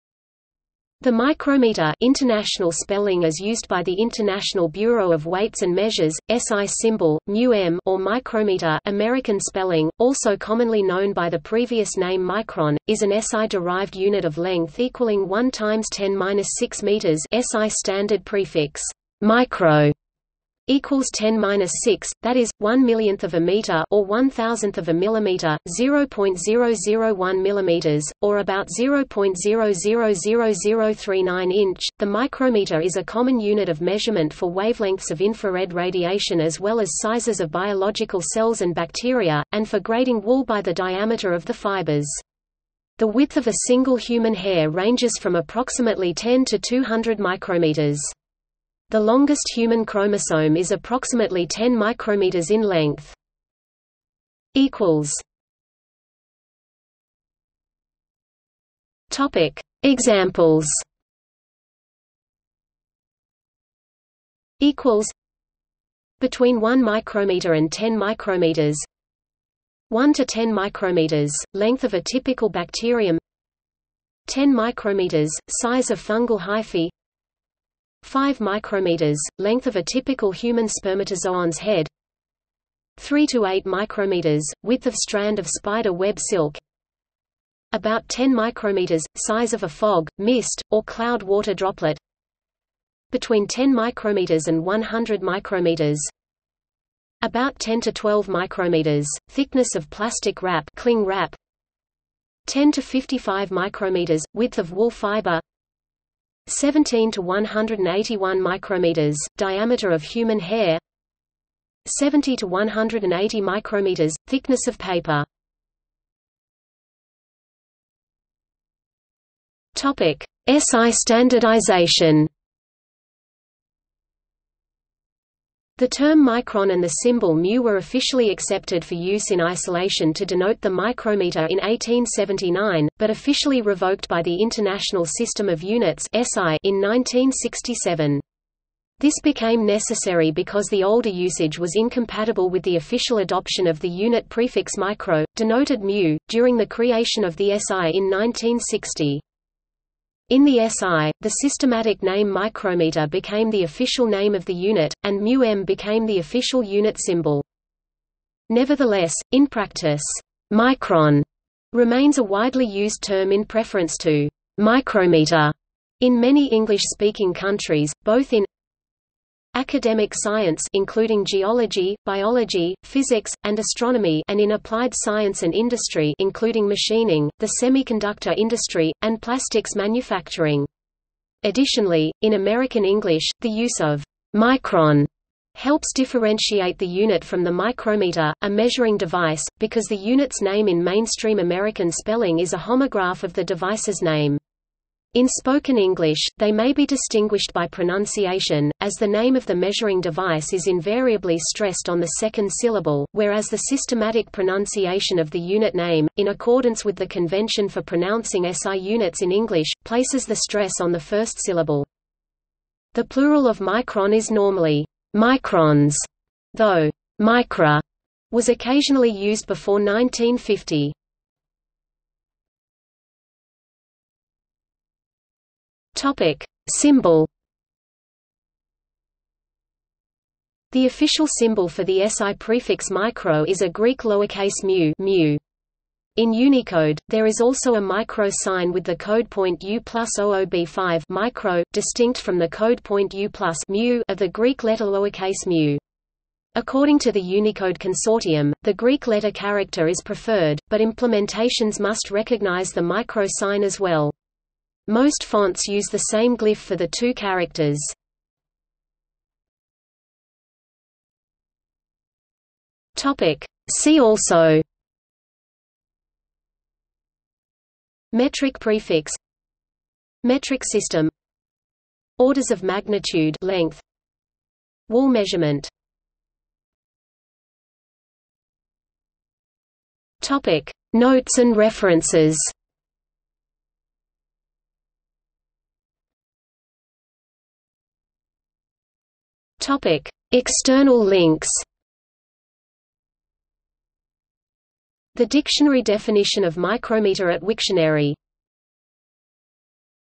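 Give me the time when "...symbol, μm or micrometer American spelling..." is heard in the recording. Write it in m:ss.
0:06.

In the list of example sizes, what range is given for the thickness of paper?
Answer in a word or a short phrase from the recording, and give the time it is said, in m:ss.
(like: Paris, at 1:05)
70 to 180 micrometers, at 1:51.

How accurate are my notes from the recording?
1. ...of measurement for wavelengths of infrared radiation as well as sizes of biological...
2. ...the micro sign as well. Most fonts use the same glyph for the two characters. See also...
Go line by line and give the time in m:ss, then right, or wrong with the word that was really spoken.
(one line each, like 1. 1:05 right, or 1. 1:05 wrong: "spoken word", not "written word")
1. 0:33 right
2. 4:12 right.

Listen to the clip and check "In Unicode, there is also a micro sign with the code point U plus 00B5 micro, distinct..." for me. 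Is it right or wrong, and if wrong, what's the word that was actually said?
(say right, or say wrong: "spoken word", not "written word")
right.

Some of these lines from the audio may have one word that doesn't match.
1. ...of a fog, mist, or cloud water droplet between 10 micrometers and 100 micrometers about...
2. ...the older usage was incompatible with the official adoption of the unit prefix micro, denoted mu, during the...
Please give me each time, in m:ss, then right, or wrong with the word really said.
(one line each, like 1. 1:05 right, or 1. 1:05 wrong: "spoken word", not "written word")
1. 1:29 right
2. 2:20 right.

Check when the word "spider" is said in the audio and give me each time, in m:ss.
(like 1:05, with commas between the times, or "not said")
1:25.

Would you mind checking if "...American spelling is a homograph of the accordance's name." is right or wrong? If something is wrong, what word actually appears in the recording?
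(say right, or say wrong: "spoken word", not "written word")
wrong: "device", not "accordance".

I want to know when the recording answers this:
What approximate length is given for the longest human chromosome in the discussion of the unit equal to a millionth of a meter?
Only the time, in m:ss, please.
0:50.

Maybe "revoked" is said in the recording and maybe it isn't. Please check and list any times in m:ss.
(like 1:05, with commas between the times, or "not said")
2:13.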